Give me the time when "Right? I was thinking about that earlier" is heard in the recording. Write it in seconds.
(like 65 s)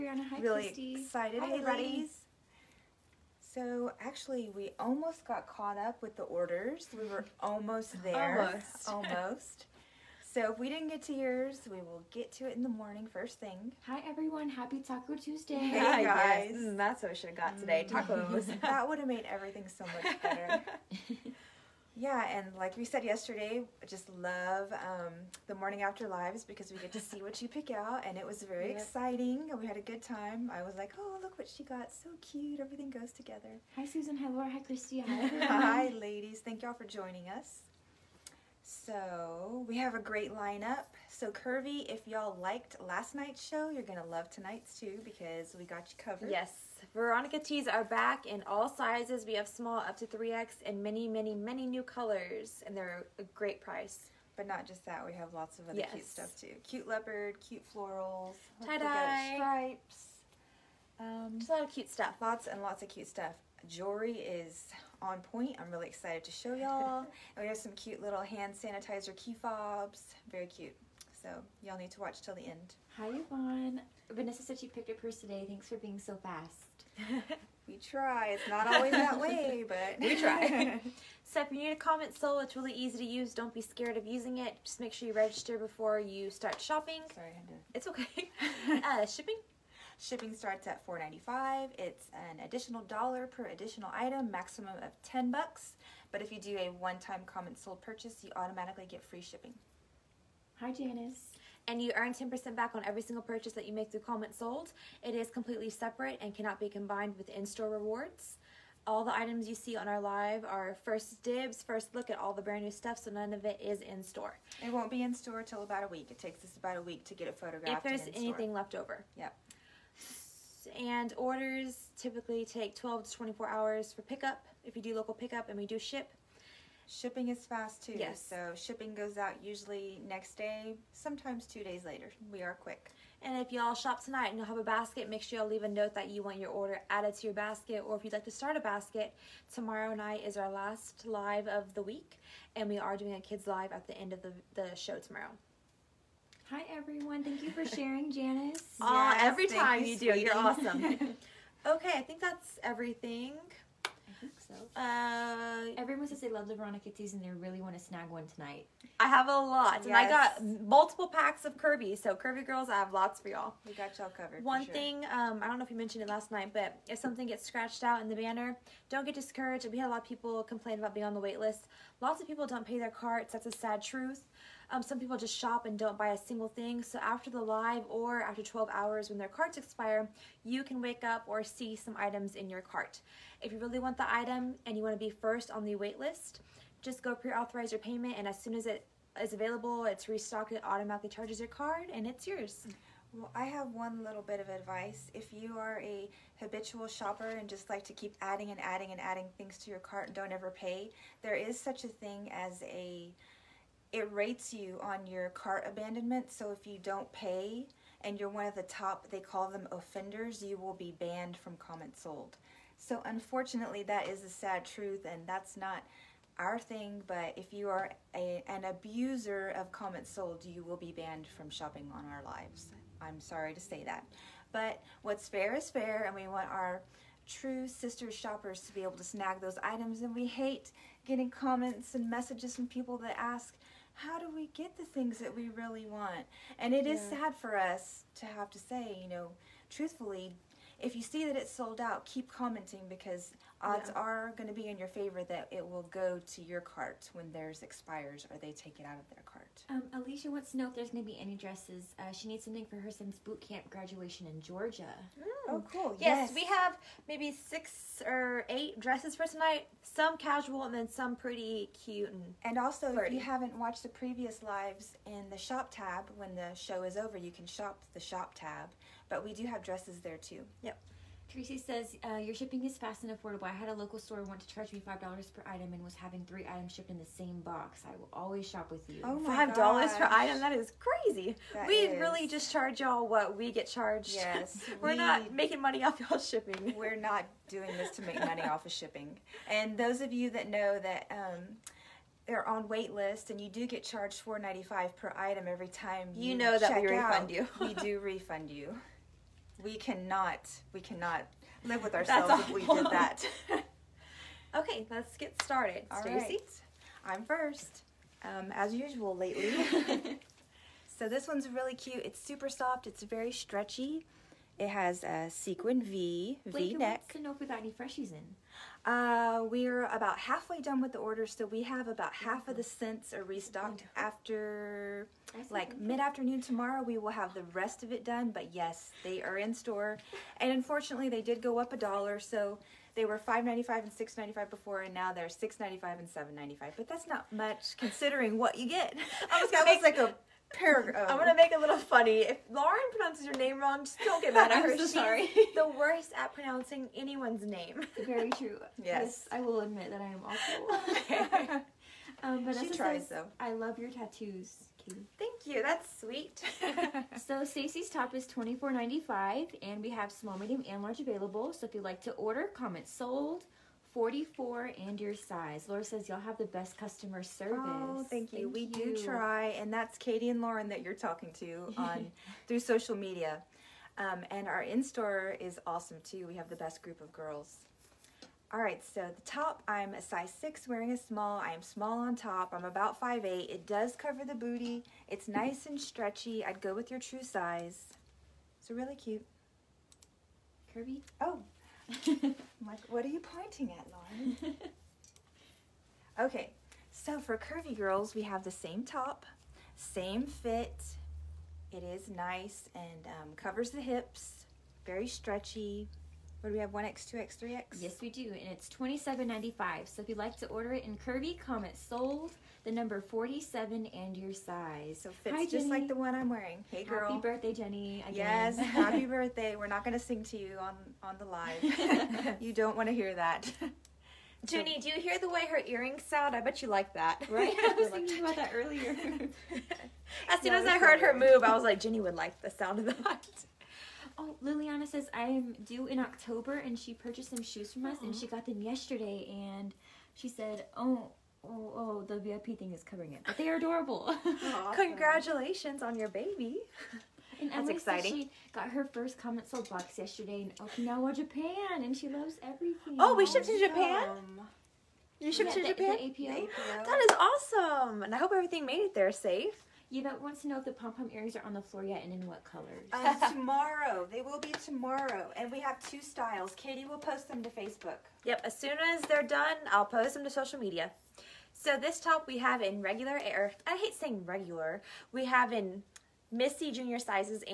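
427 s.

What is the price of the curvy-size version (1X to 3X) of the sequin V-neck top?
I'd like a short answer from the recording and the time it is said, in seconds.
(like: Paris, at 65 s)
$27.95, at 408 s.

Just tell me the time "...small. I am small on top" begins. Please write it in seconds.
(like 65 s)
380 s.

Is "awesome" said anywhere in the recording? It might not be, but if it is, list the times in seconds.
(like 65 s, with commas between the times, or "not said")
150 s, 375 s, 444 s, 457 s.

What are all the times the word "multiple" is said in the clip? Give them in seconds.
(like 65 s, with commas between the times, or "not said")
160 s.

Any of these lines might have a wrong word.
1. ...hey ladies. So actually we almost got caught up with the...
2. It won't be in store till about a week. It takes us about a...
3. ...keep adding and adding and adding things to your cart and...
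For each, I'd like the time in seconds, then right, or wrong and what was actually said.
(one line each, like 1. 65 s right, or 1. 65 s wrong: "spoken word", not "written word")
1. 1 s right
2. 114 s right
3. 197 s right.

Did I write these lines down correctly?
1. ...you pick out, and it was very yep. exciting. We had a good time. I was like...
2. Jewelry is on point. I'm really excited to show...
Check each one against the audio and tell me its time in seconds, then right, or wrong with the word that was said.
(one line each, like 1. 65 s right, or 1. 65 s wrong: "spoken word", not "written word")
1. 27 s right
2. 63 s right.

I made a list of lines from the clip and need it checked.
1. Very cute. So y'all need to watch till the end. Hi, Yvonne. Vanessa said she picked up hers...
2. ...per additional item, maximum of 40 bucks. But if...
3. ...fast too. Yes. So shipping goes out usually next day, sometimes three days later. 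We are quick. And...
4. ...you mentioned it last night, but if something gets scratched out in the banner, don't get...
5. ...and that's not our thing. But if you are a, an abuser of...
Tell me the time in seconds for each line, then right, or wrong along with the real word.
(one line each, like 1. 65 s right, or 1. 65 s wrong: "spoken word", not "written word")
1. 70 s right
2. 93 s wrong: "10", not "40"
3. 127 s wrong: "two", not "three"
4. 165 s right
5. 215 s right.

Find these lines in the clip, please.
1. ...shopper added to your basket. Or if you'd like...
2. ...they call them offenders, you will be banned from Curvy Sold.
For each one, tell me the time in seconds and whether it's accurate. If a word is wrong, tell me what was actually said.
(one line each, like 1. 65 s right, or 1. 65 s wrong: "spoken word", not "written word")
1. 136 s wrong: "order", not "shopper"
2. 209 s wrong: "Comment", not "Curvy".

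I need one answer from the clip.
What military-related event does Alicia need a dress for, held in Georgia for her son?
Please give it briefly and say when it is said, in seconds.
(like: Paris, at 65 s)
boot camp graduation, at 253 s.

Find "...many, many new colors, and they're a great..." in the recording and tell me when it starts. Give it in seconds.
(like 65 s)
51 s.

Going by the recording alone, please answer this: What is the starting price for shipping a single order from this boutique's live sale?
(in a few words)
$4.95.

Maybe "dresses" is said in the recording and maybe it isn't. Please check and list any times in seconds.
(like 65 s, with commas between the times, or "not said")
251 s, 258 s, 269 s.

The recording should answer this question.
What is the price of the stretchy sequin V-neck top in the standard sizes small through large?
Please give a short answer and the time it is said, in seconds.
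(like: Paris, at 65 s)
$24.95, at 358 s.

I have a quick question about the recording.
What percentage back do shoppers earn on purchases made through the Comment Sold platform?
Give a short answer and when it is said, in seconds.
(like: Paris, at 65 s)
10%, at 102 s.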